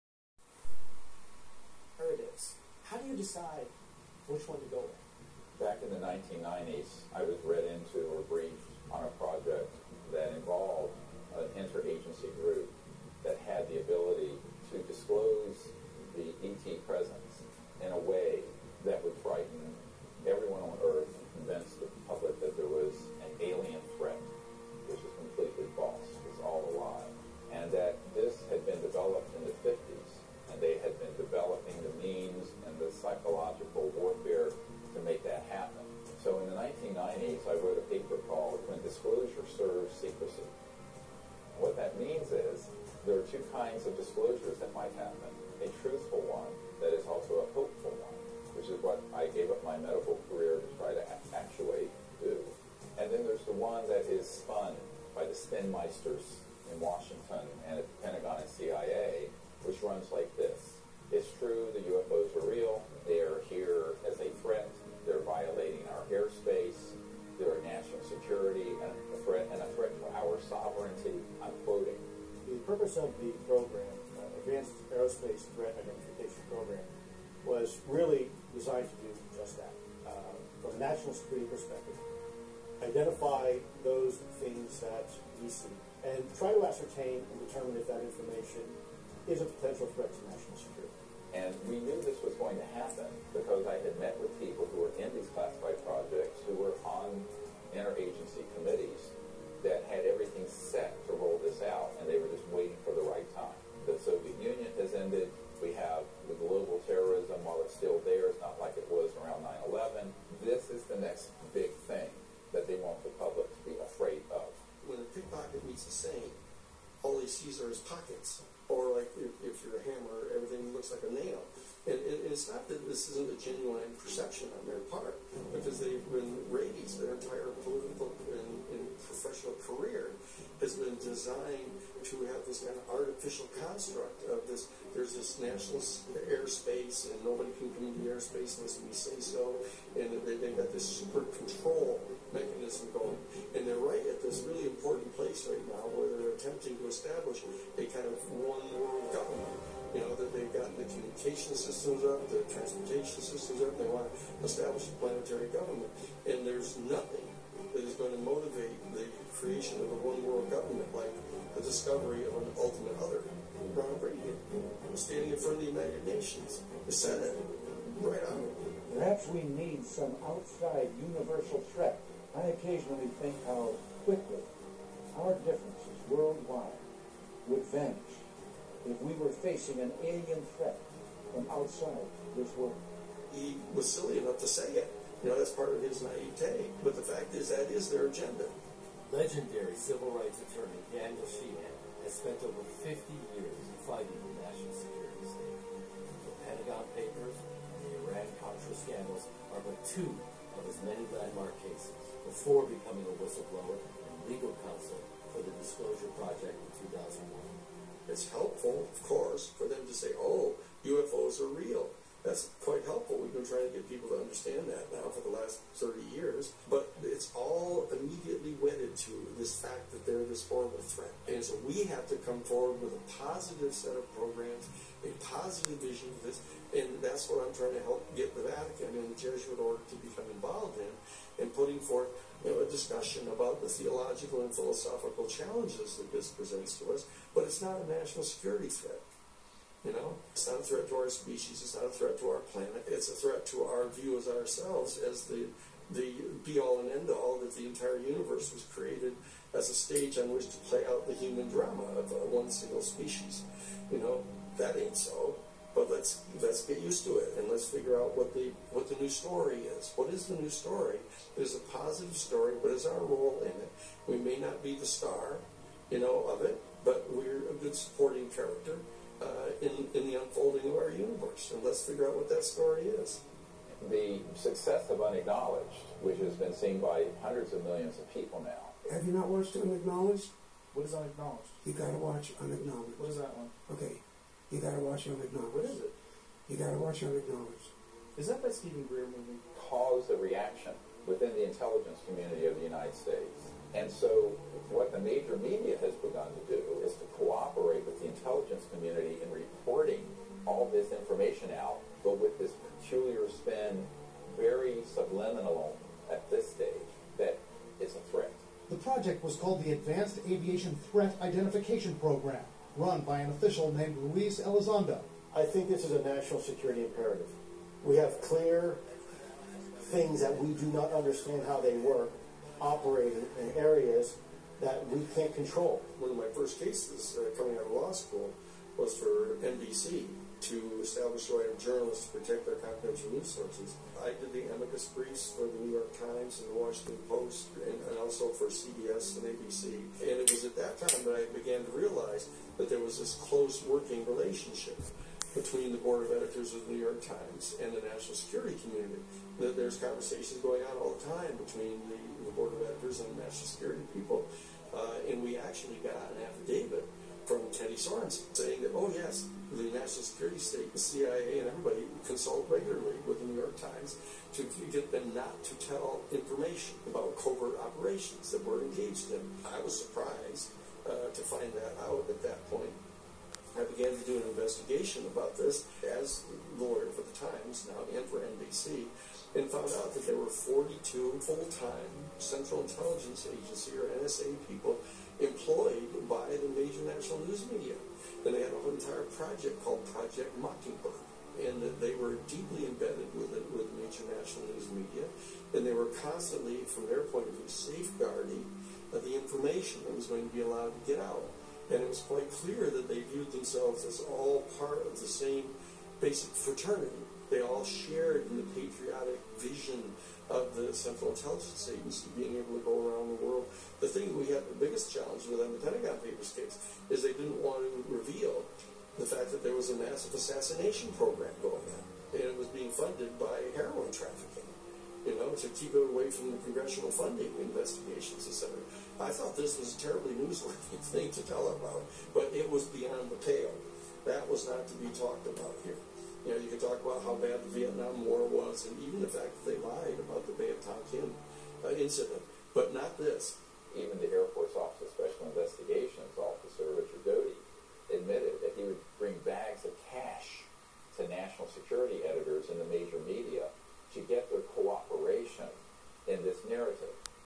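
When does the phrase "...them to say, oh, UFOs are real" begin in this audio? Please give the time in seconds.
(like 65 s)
209 s.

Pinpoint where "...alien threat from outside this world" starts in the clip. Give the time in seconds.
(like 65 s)
180 s.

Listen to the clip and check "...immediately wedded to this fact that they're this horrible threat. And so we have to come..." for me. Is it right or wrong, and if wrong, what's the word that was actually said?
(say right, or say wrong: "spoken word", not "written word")
right.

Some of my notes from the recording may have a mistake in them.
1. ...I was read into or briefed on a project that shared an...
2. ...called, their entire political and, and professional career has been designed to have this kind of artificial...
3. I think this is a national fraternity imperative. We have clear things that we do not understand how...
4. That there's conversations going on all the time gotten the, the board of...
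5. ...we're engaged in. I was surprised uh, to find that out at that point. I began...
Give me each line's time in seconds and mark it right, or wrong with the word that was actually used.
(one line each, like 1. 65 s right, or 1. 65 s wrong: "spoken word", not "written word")
1. 7 s wrong: "involved", not "shared"
2. 126 s wrong: "raised", not "called"
3. 315 s wrong: "security", not "fraternity"
4. 349 s wrong: "between", not "gotten"
5. 368 s right.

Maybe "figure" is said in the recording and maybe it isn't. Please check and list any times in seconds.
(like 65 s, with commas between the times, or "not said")
257 s, 271 s.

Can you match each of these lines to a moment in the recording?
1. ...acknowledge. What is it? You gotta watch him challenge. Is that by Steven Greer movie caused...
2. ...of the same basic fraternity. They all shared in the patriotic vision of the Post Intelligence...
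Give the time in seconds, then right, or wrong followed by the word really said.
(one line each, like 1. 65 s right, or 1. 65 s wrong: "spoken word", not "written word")
1. 285 s wrong: "acknowledge", not "challenge"
2. 404 s wrong: "Central", not "Post".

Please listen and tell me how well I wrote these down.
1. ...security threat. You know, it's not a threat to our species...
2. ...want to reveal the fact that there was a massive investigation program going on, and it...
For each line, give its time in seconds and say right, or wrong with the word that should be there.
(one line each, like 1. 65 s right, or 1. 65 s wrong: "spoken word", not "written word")
1. 238 s right
2. 417 s wrong: "assassination", not "investigation".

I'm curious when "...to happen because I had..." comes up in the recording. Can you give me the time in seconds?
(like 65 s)
92 s.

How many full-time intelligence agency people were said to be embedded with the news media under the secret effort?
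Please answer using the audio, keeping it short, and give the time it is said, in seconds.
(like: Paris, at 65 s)
42, at 380 s.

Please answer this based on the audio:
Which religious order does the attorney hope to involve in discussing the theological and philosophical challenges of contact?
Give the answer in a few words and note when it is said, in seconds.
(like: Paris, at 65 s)
Jesuit order, at 229 s.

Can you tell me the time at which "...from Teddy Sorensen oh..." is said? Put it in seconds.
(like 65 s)
357 s.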